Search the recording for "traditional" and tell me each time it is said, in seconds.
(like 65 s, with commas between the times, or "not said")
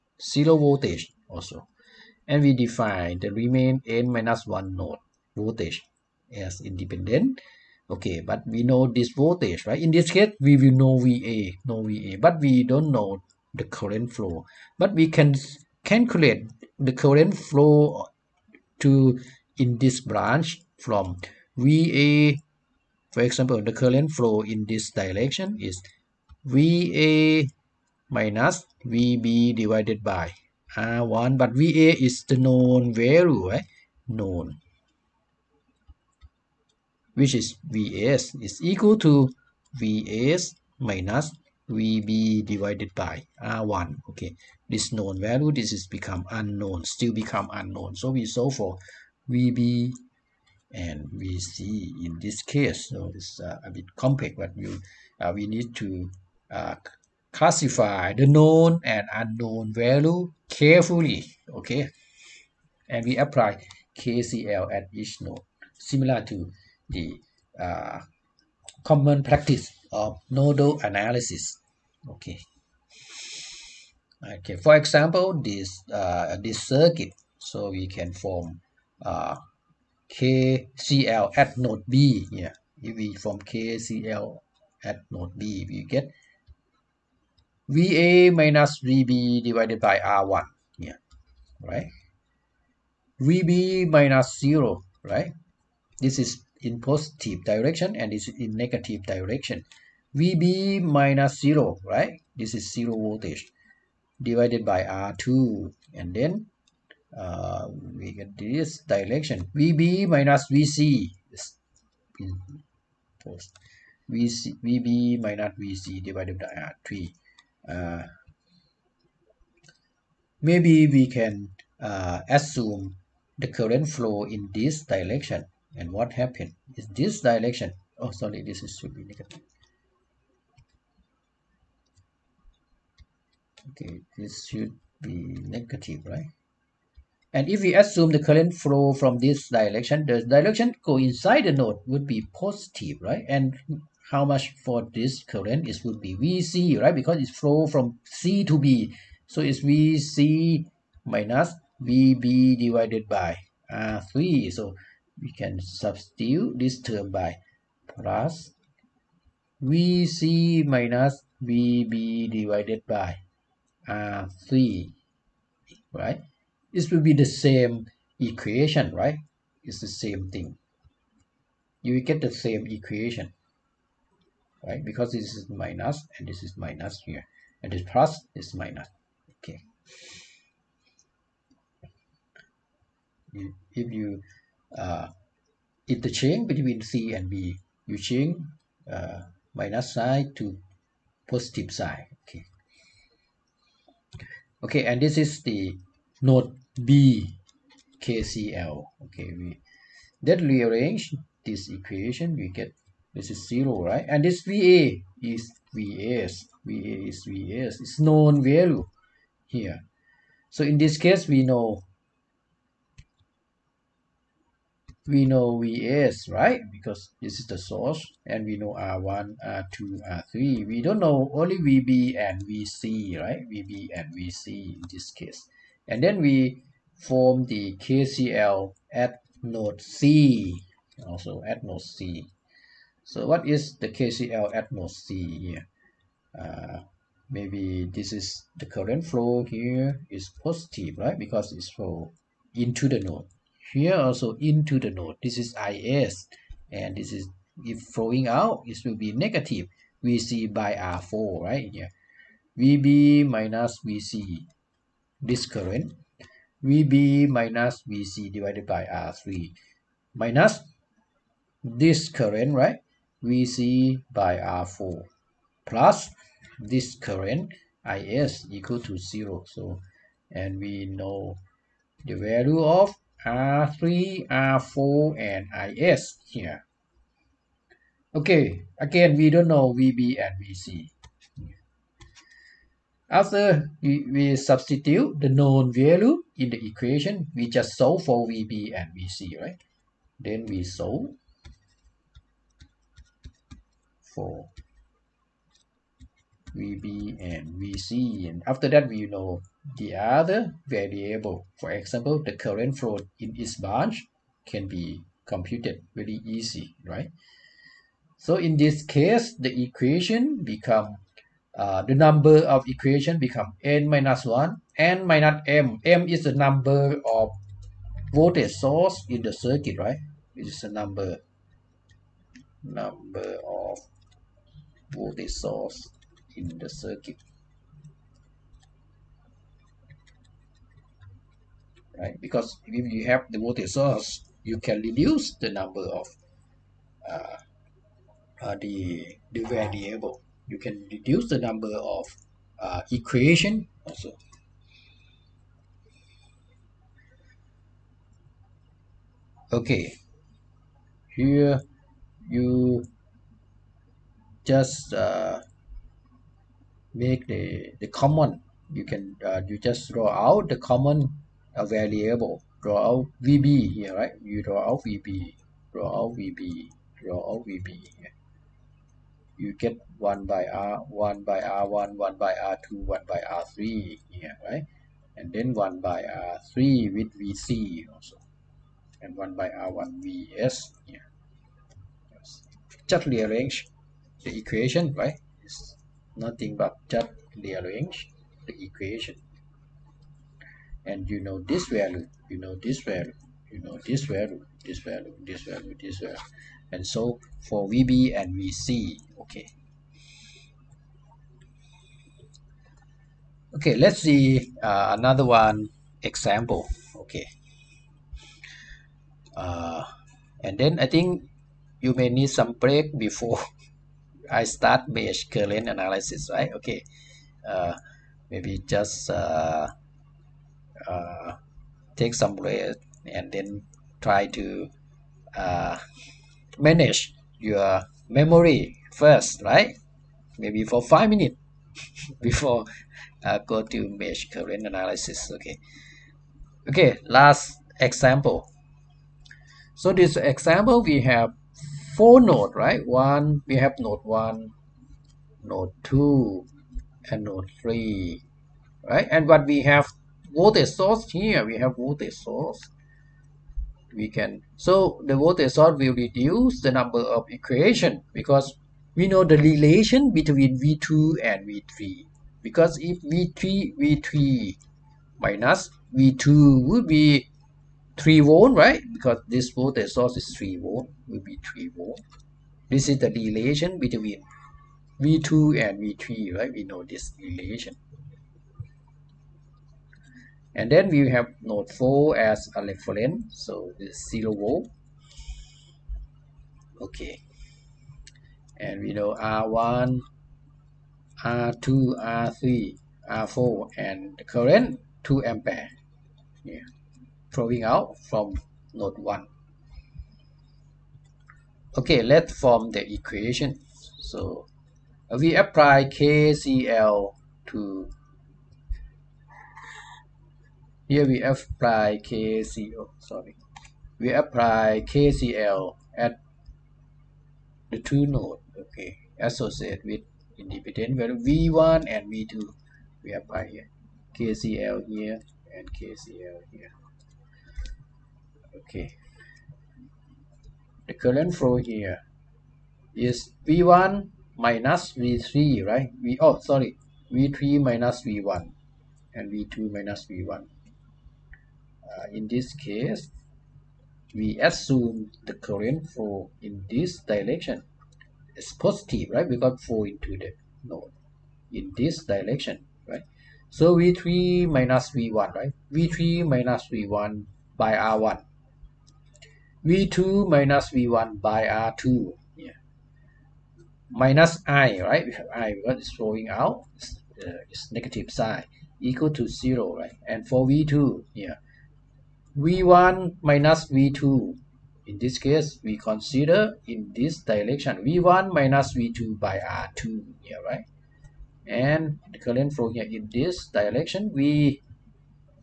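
not said.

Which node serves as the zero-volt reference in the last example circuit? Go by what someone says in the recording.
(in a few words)
Node 4.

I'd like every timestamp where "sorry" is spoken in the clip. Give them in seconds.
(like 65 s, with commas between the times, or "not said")
128 s, 512 s, 536 s.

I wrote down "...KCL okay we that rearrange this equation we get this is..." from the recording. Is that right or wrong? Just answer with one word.
right.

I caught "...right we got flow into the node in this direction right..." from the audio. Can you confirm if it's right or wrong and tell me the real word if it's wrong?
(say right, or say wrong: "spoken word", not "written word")
right.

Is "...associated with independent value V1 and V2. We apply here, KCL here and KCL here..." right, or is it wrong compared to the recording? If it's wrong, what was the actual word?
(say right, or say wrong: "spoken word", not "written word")
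right.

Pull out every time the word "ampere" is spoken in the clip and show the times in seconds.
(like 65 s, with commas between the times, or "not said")
495 s.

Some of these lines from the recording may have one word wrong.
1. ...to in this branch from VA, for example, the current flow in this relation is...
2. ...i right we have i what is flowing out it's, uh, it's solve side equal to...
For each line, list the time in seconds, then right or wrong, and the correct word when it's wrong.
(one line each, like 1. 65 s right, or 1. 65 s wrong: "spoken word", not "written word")
1. 18 s wrong: "direction", not "relation"
2. 564 s wrong: "negative", not "solve".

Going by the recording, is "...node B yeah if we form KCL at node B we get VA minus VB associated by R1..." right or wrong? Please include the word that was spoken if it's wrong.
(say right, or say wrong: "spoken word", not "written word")
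wrong: "divided", not "associated".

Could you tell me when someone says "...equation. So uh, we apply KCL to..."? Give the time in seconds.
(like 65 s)
502 s.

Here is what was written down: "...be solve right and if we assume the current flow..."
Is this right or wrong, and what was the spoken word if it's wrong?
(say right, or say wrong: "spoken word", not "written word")
wrong: "negative", not "solve".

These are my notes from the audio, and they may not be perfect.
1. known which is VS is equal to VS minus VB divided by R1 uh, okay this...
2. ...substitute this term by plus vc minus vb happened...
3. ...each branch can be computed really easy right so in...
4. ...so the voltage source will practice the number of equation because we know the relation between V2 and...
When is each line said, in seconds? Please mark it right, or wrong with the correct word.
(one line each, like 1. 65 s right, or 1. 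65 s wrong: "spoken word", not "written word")
1. 34 s right
2. 155 s wrong: "divided", not "happened"
3. 303 s right
4. 454 s wrong: "reduce", not "practice".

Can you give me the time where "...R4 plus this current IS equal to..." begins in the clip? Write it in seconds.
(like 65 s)
264 s.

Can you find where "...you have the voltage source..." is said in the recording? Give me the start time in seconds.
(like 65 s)
332 s.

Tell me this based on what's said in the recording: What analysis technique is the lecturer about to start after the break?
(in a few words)
Mesh current analysis.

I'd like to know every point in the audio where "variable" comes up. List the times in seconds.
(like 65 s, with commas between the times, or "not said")
300 s, 339 s, 361 s.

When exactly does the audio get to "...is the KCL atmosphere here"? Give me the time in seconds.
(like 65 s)
233 s.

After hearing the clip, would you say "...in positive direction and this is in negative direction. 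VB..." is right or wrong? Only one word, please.
right.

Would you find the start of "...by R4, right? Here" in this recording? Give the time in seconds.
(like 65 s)
250 s.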